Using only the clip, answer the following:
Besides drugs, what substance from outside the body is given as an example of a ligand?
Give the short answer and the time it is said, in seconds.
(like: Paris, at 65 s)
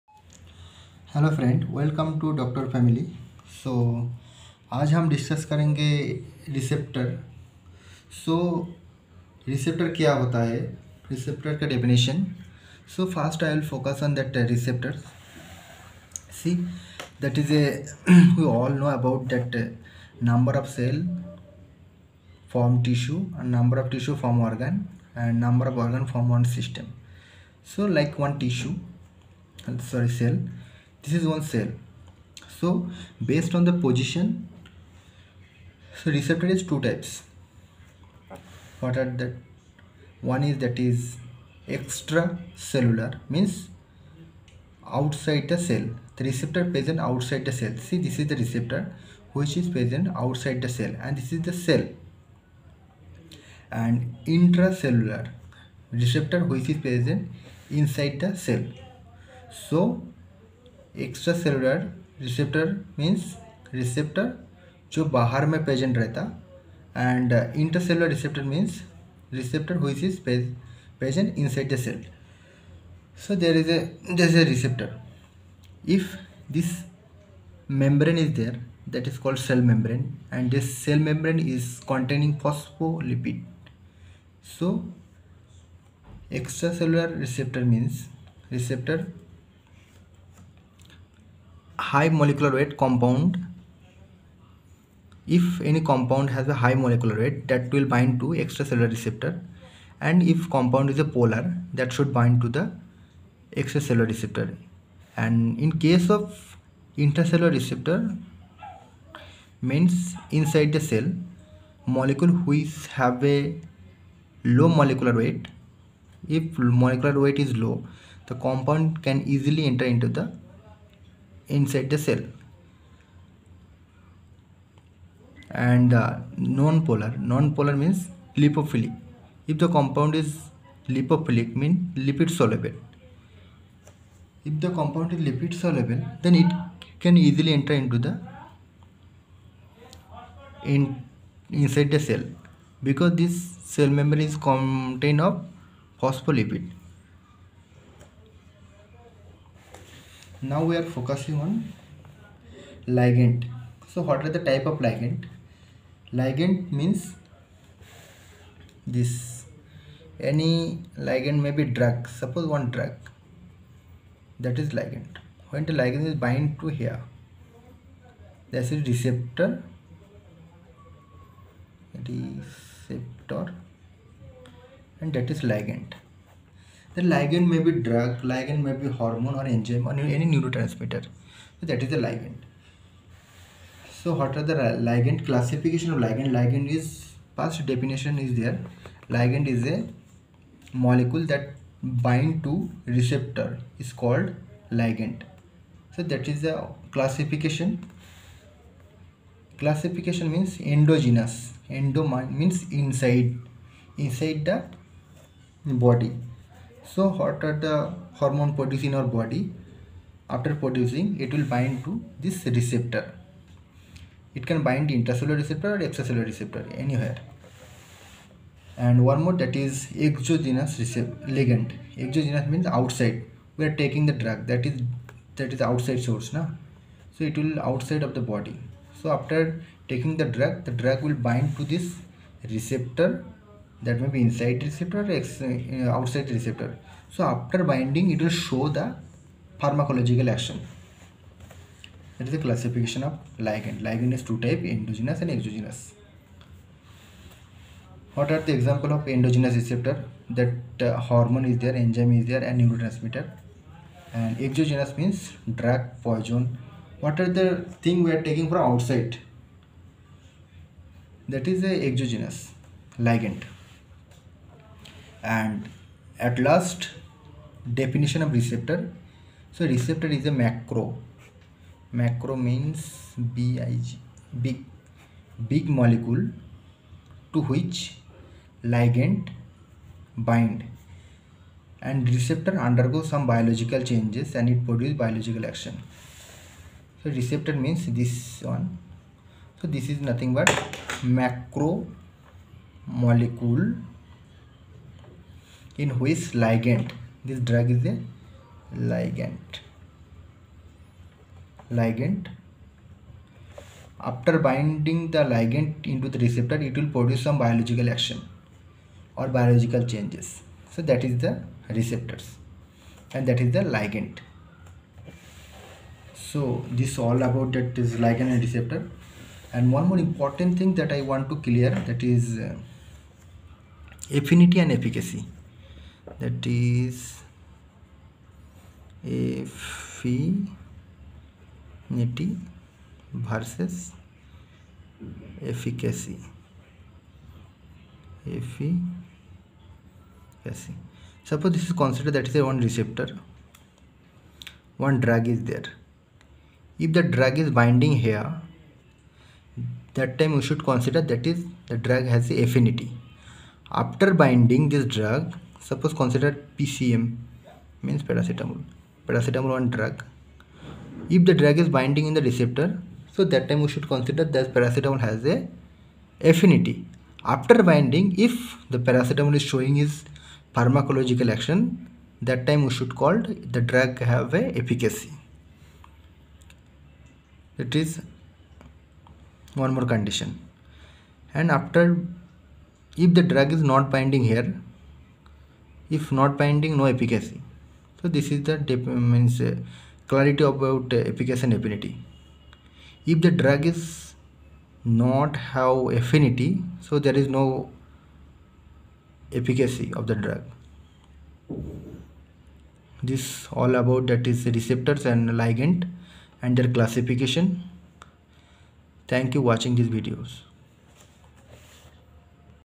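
poison, at 256 s.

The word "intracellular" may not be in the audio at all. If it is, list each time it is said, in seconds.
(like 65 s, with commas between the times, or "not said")
54 s, 106 s, 214 s.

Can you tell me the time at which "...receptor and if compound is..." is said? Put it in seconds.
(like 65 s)
98 s.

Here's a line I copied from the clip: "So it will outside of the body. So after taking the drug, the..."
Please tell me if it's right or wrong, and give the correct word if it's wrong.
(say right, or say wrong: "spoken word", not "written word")
right.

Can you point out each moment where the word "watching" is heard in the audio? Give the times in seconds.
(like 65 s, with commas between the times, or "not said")
409 s.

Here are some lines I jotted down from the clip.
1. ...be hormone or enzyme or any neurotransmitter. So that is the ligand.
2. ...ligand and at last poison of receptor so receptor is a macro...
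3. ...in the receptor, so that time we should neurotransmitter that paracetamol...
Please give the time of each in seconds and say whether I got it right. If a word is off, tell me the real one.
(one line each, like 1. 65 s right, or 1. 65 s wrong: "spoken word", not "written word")
1. 178 s right
2. 262 s wrong: "definition", not "poison"
3. 362 s wrong: "consider", not "neurotransmitter".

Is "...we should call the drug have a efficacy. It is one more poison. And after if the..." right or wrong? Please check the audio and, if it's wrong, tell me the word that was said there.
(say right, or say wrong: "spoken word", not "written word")
wrong: "condition", not "poison".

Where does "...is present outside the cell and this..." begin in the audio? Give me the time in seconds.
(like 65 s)
49 s.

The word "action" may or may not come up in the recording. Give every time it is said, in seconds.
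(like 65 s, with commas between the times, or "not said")
240 s, 285 s, 307 s, 371 s.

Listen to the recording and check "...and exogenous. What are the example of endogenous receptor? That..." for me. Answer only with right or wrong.
right.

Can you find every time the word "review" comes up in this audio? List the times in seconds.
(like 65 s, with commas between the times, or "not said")
not said.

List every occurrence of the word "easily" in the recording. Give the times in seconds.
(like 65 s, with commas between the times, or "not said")
119 s, 137 s.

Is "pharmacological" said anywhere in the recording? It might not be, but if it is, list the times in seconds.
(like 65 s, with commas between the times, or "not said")
239 s, 370 s.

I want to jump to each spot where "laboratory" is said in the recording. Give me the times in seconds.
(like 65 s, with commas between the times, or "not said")
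not said.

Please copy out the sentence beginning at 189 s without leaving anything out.
Ligand is a molecule that bind to receptor is called ligand.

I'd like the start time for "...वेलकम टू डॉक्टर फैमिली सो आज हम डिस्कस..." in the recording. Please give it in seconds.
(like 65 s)
1 s.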